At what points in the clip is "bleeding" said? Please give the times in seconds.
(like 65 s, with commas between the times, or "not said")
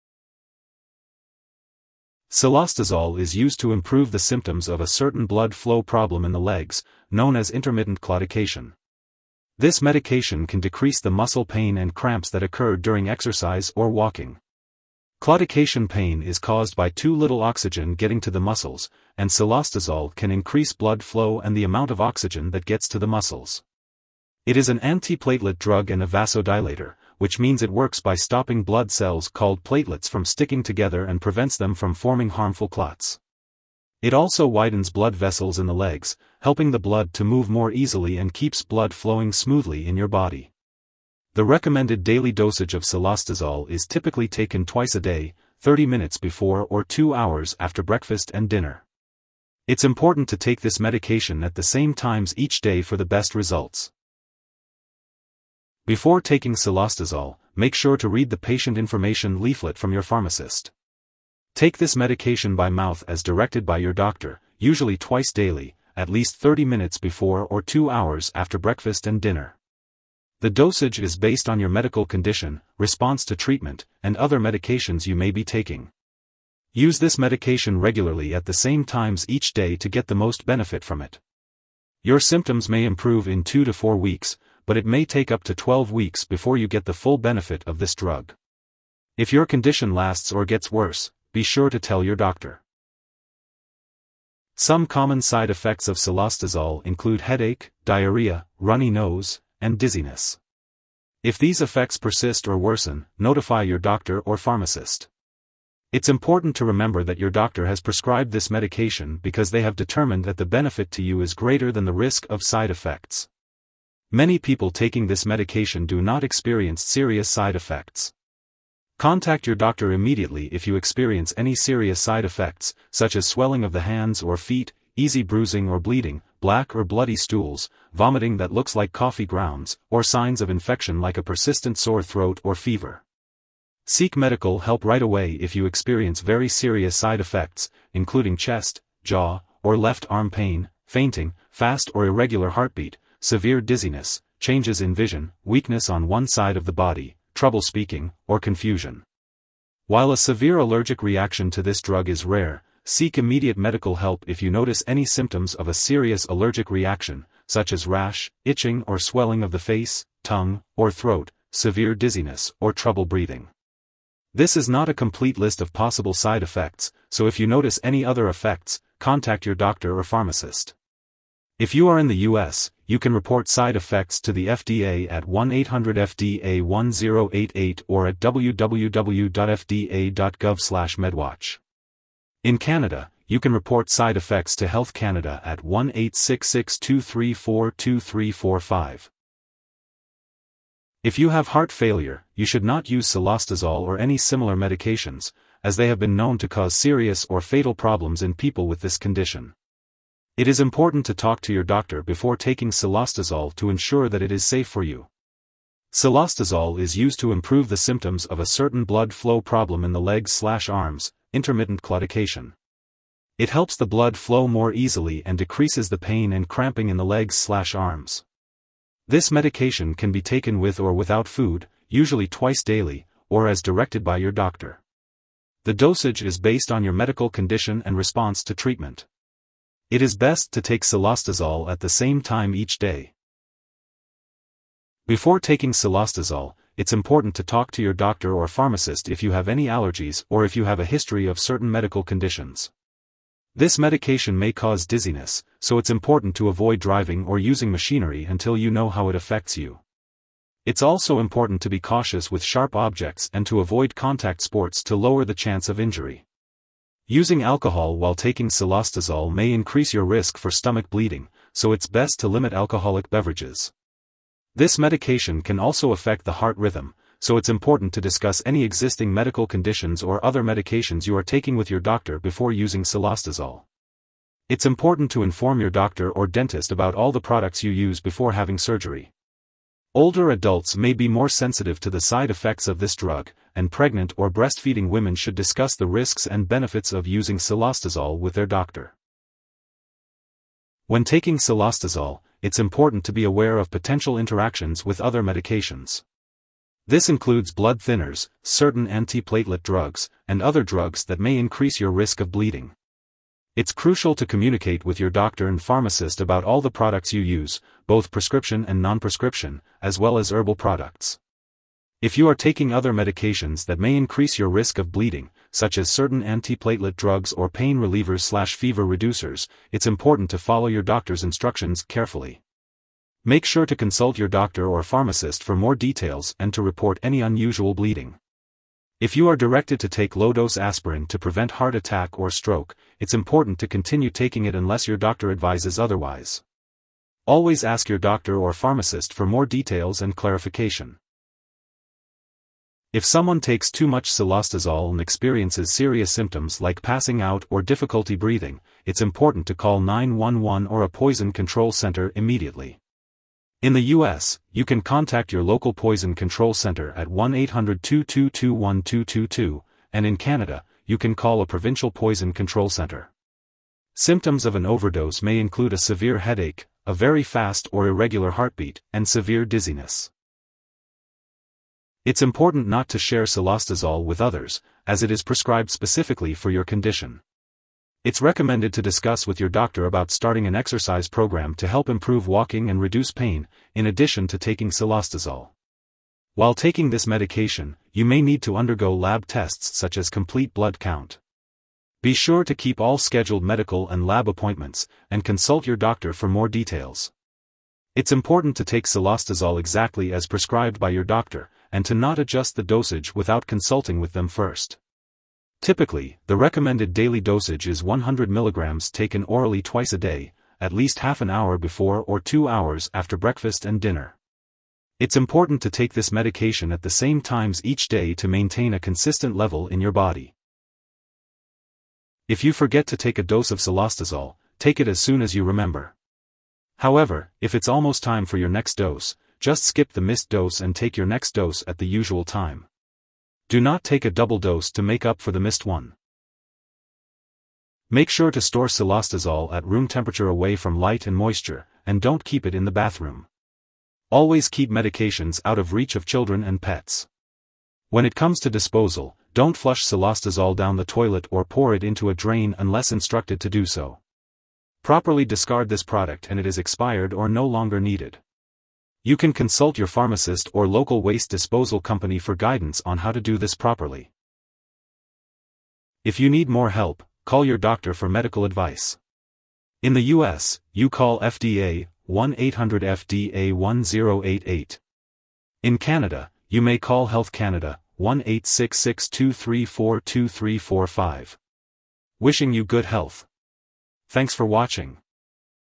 125 s, 260 s, 302 s, 314 s, 327 s.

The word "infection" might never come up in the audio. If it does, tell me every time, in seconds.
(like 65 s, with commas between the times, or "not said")
130 s.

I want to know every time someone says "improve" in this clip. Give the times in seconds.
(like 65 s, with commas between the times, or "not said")
3 s, 82 s, 207 s, 381 s.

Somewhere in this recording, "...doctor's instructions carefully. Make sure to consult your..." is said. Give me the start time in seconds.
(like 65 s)
320 s.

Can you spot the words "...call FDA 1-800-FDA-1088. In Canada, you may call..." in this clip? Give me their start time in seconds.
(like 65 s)
470 s.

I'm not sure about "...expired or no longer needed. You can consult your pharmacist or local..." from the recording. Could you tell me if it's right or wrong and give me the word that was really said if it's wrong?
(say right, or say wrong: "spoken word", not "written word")
right.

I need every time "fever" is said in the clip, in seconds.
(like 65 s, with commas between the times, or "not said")
132 s, 318 s.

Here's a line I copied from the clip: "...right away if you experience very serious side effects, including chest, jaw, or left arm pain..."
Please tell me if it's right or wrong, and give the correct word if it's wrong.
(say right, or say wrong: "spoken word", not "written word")
right.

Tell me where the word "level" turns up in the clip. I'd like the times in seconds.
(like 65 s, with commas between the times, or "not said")
419 s.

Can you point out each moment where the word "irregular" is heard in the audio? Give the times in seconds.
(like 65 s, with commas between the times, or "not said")
142 s, 367 s.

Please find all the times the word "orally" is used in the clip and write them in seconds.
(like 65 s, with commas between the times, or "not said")
409 s.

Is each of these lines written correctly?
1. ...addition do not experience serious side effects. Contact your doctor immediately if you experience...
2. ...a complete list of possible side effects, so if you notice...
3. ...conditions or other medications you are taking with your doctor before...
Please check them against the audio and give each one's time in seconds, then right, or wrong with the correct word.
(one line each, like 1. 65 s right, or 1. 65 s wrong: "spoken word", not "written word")
1. 115 s wrong: "medication", not "addition"
2. 164 s right
3. 269 s right.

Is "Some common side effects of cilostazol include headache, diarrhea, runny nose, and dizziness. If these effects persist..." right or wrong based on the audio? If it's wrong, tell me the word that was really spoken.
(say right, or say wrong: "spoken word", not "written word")
right.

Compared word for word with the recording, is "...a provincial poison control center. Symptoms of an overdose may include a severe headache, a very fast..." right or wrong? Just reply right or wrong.
right.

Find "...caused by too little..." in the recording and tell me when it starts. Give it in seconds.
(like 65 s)
16 s.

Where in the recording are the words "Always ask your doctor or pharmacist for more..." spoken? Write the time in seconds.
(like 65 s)
337 s.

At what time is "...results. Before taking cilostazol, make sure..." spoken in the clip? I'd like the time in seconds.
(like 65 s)
53 s.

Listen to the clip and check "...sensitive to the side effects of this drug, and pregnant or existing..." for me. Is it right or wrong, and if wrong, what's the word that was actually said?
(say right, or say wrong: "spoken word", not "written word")
wrong: "breastfeeding", not "existing".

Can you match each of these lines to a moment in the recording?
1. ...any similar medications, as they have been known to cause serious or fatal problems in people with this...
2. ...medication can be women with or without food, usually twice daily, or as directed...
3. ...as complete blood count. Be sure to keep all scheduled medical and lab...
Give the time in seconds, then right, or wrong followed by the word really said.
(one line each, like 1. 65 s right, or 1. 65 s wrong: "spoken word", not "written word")
1. 193 s right
2. 219 s wrong: "taken", not "women"
3. 389 s right.